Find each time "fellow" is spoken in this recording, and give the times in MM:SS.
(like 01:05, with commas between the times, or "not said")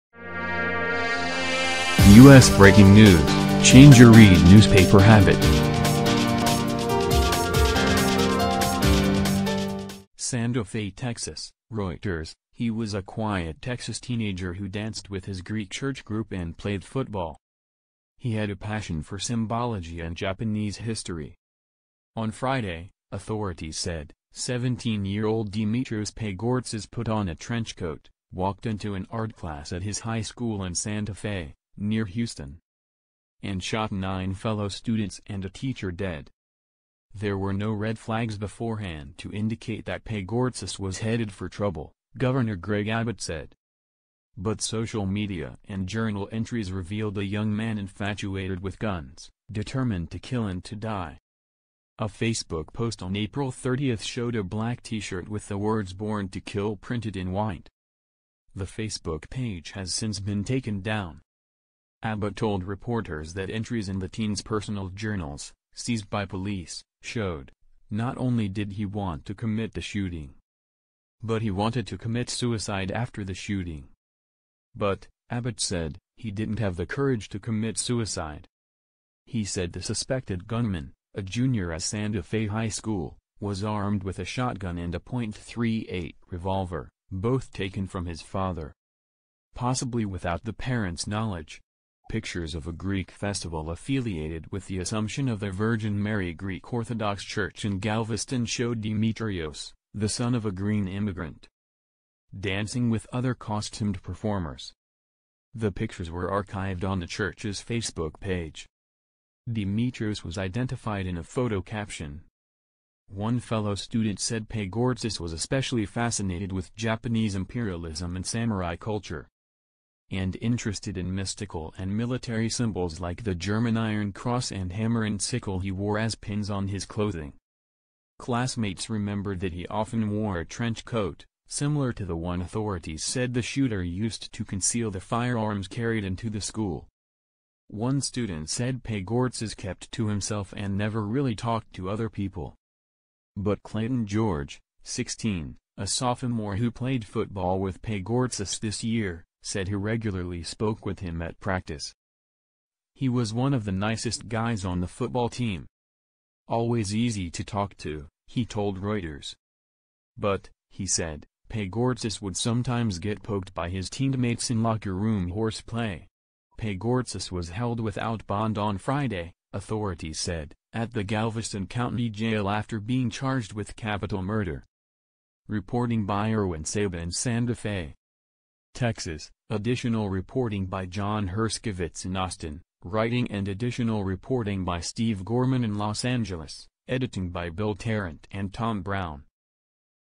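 00:34, 01:53.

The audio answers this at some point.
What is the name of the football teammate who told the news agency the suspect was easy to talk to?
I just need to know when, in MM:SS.
02:23.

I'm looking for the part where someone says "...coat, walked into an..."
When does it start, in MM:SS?
00:27.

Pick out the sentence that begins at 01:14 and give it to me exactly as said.
But, Abbott said, he didn't have the courage to commit suicide.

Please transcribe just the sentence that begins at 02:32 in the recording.
He was one of the nicest guys on the football team.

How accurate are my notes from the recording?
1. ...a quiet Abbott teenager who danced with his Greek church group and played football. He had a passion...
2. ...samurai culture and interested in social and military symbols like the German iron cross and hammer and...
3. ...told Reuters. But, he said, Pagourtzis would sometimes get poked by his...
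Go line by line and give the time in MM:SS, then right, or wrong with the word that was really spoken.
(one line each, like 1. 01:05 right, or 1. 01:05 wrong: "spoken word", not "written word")
1. 00:12 wrong: "Texas", not "Abbott"
2. 01:58 wrong: "mystical", not "social"
3. 02:38 right.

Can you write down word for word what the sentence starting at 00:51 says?
A Facebook post on April 30 showed a black t-shirt with the words Born to Kill printed in white.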